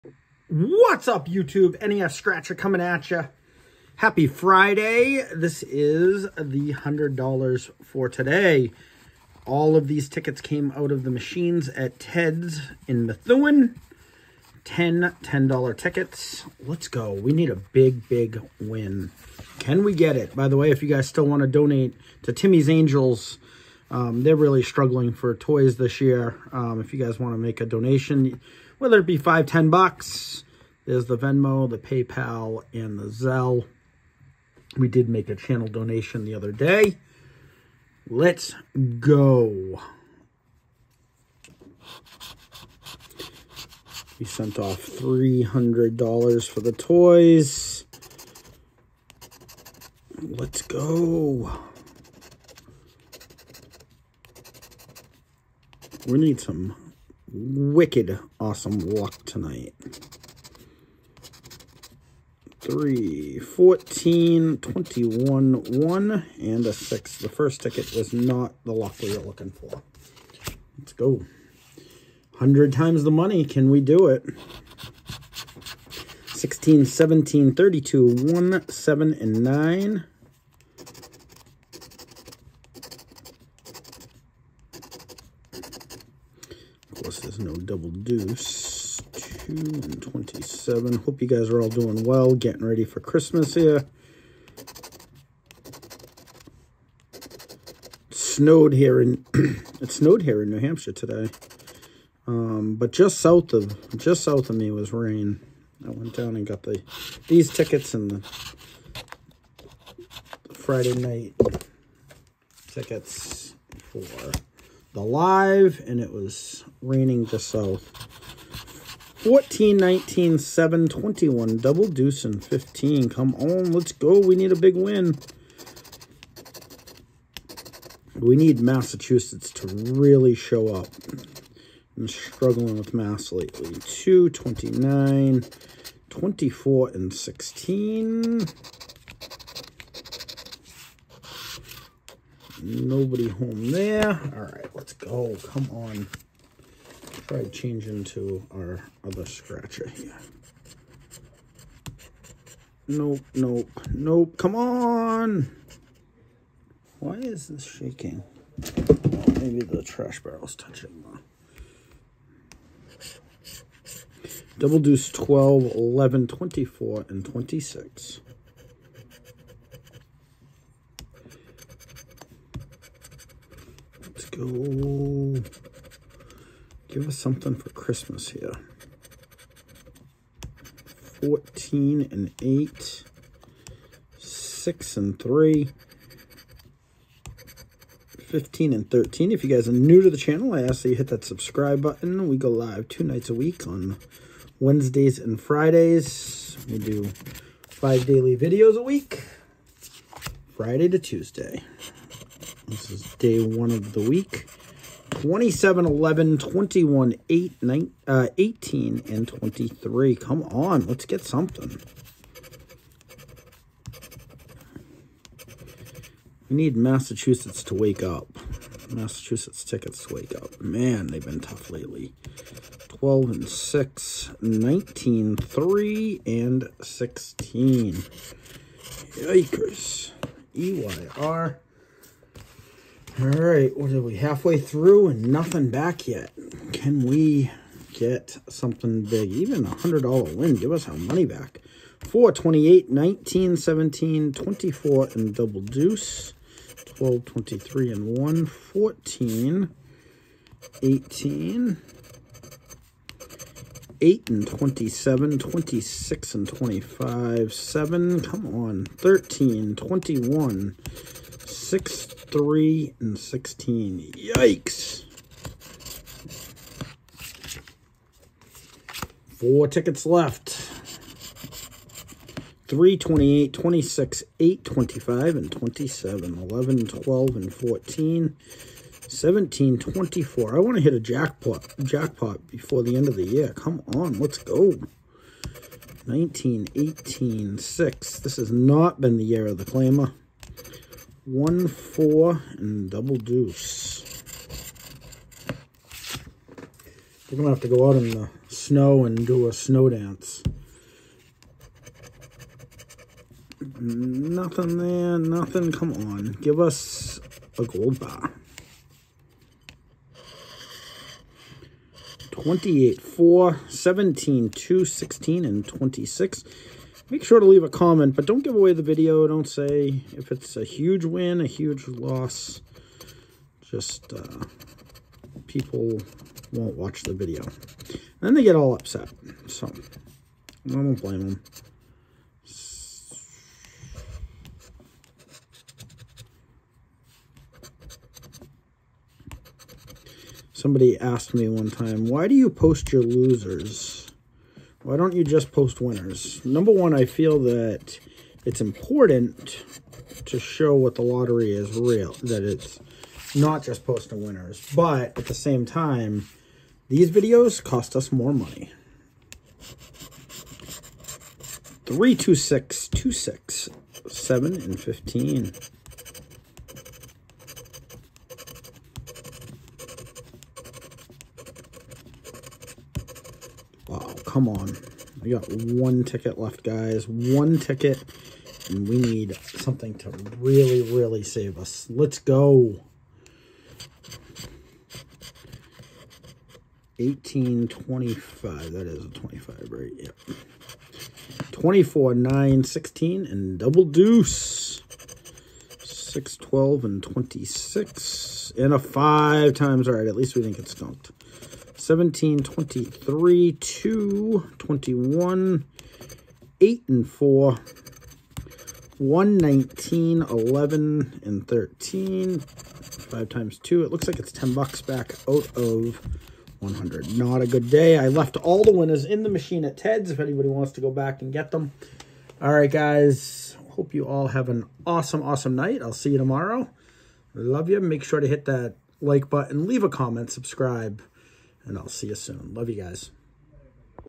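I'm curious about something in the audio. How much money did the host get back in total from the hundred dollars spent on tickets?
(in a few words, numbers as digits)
$10.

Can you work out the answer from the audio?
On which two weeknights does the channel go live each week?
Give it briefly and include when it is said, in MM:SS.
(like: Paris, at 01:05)
Wednesdays and Fridays, at 03:14.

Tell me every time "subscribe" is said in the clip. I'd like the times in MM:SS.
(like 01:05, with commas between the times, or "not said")
03:11, 07:10.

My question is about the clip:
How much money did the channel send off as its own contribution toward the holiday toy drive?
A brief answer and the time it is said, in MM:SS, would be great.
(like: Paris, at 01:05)
$300, at 00:44.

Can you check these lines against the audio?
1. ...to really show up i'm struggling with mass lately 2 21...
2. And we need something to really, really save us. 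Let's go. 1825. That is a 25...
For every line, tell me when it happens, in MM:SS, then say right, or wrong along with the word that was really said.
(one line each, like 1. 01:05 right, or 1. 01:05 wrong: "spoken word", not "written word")
1. 02:09 wrong: "29", not "21"
2. 06:18 right.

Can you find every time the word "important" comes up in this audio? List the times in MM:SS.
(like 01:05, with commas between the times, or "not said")
05:48.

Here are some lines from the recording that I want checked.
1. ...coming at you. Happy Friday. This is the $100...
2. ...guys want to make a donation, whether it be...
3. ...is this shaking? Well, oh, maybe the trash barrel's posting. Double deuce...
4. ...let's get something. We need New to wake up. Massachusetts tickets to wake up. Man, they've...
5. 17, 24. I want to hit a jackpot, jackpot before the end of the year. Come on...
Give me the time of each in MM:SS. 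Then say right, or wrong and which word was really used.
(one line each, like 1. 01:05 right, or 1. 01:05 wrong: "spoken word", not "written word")
1. 00:02 right
2. 00:27 right
3. 02:37 wrong: "touching", not "posting"
4. 03:30 wrong: "Massachusetts", not "New"
5. 04:39 right.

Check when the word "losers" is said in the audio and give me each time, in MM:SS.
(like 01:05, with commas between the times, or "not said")
05:43.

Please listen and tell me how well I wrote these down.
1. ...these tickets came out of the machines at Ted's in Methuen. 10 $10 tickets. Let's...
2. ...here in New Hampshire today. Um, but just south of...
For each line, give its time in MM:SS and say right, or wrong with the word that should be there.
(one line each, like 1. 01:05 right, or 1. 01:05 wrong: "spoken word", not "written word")
1. 00:09 right
2. 01:40 right.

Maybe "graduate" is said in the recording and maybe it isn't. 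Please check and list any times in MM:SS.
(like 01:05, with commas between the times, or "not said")
not said.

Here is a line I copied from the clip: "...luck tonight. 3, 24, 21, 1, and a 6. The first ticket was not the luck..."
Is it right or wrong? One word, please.
wrong.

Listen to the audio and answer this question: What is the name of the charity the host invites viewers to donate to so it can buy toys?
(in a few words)
Timmy's Angels.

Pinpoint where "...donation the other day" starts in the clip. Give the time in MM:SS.
00:35.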